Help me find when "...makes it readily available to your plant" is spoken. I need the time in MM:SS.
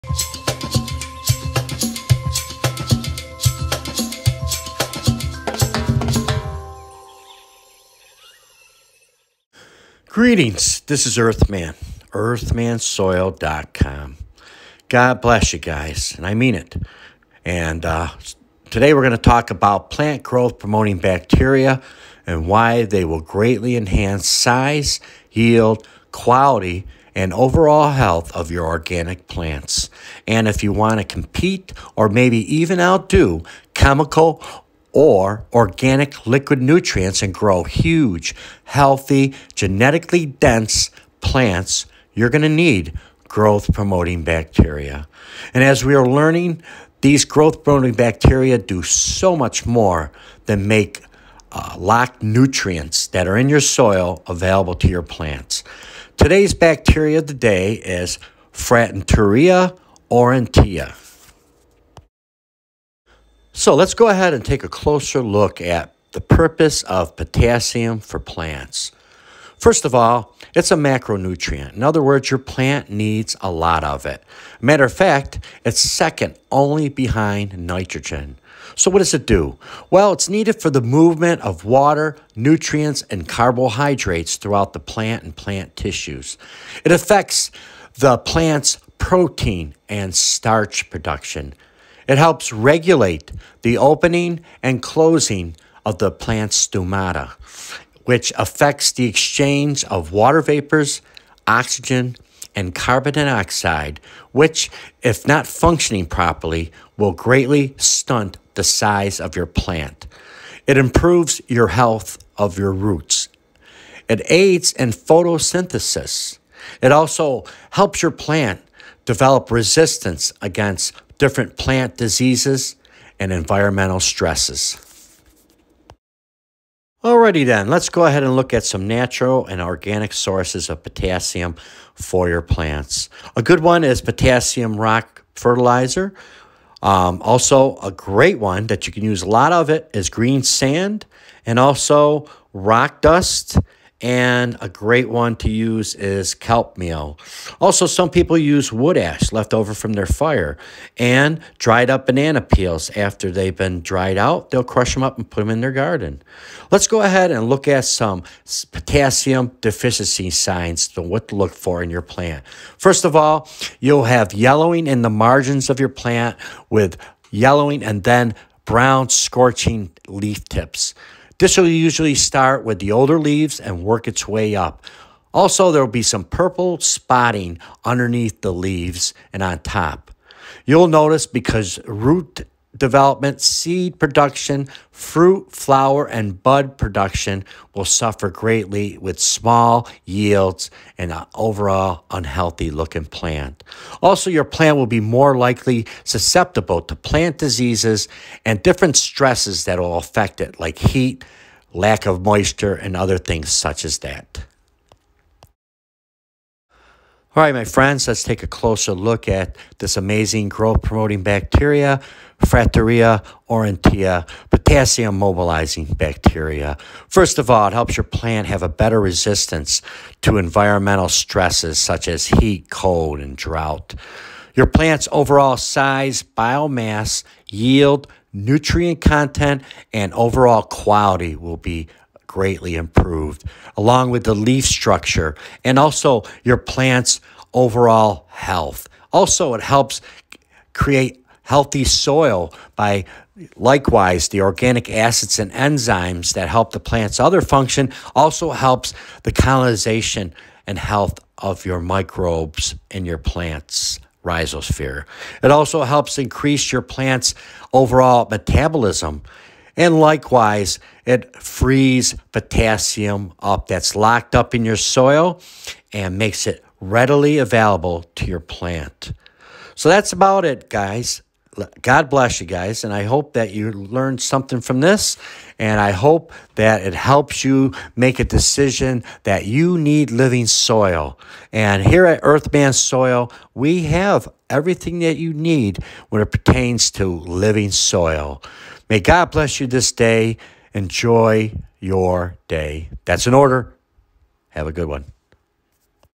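04:26.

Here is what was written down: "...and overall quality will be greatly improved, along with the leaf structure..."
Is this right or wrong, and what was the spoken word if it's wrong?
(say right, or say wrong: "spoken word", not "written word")
right.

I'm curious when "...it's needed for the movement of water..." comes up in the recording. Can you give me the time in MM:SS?
01:20.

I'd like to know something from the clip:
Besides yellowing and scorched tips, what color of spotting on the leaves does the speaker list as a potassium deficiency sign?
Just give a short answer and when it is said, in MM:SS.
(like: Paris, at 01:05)
Purple, at 02:56.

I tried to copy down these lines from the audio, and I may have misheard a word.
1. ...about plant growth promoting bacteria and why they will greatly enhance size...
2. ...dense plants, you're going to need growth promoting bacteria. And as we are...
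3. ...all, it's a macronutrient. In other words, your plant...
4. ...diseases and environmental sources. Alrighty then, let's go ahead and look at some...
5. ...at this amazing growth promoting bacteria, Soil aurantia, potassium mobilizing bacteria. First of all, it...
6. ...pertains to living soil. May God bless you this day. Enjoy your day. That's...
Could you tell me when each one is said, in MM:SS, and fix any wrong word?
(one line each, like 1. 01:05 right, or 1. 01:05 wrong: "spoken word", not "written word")
1. 00:19 right
2. 00:40 right
3. 01:09 right
4. 02:01 wrong: "stresses", not "sources"
5. 03:29 wrong: "Frateuria", not "Soil"
6. 04:46 right.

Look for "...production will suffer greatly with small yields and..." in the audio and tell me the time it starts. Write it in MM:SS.
03:06.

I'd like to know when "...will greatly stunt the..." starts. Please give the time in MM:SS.
01:46.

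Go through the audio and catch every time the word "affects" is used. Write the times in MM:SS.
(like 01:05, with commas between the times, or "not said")
01:26, 01:38, 03:19.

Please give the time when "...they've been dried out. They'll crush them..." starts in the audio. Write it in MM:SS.
02:33.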